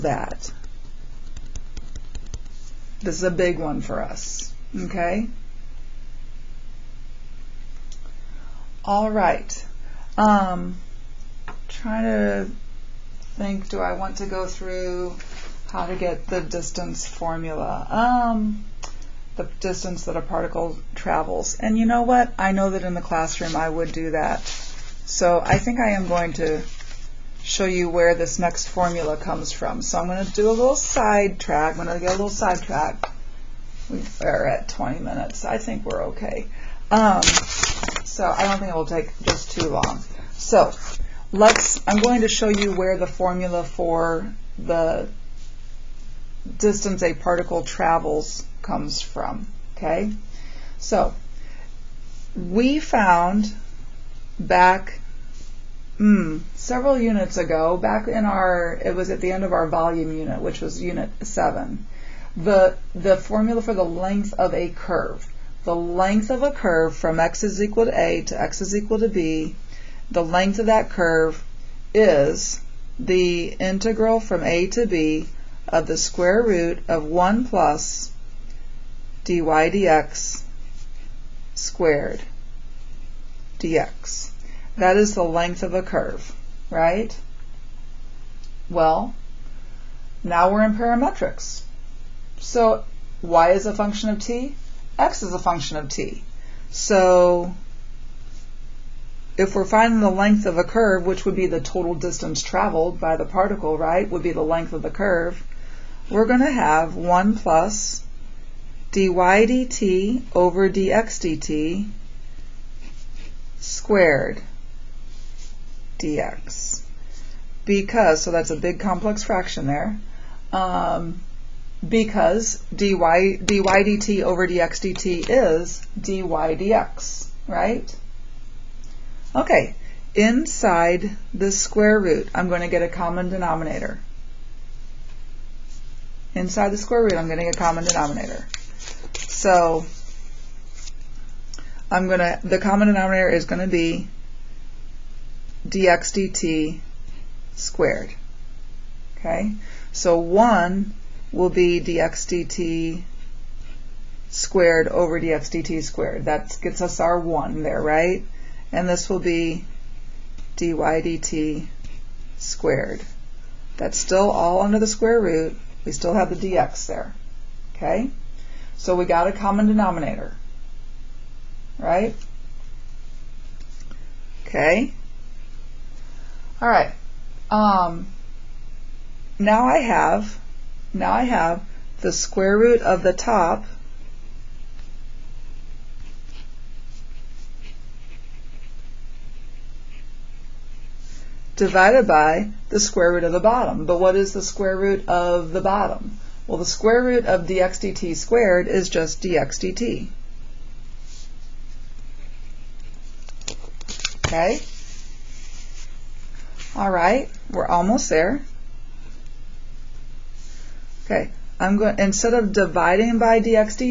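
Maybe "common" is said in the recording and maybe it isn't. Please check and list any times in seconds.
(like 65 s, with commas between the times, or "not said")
132 s, 137 s, 142 s, 169 s.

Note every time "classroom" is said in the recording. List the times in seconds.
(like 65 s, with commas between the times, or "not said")
23 s.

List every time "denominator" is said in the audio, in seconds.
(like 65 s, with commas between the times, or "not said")
133 s, 137 s, 142 s, 169 s.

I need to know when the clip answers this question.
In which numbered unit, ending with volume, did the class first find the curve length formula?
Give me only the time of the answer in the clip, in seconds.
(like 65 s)
60 s.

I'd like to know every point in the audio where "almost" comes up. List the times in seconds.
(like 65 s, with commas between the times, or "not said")
207 s.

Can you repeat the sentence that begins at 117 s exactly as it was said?
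Because, so that's a big complex fraction there, um, because dy, dy dt over dx dt is dy dx, right?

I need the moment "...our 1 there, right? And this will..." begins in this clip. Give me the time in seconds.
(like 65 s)
156 s.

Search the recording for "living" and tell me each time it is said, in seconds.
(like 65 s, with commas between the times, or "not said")
not said.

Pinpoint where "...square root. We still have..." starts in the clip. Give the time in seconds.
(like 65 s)
164 s.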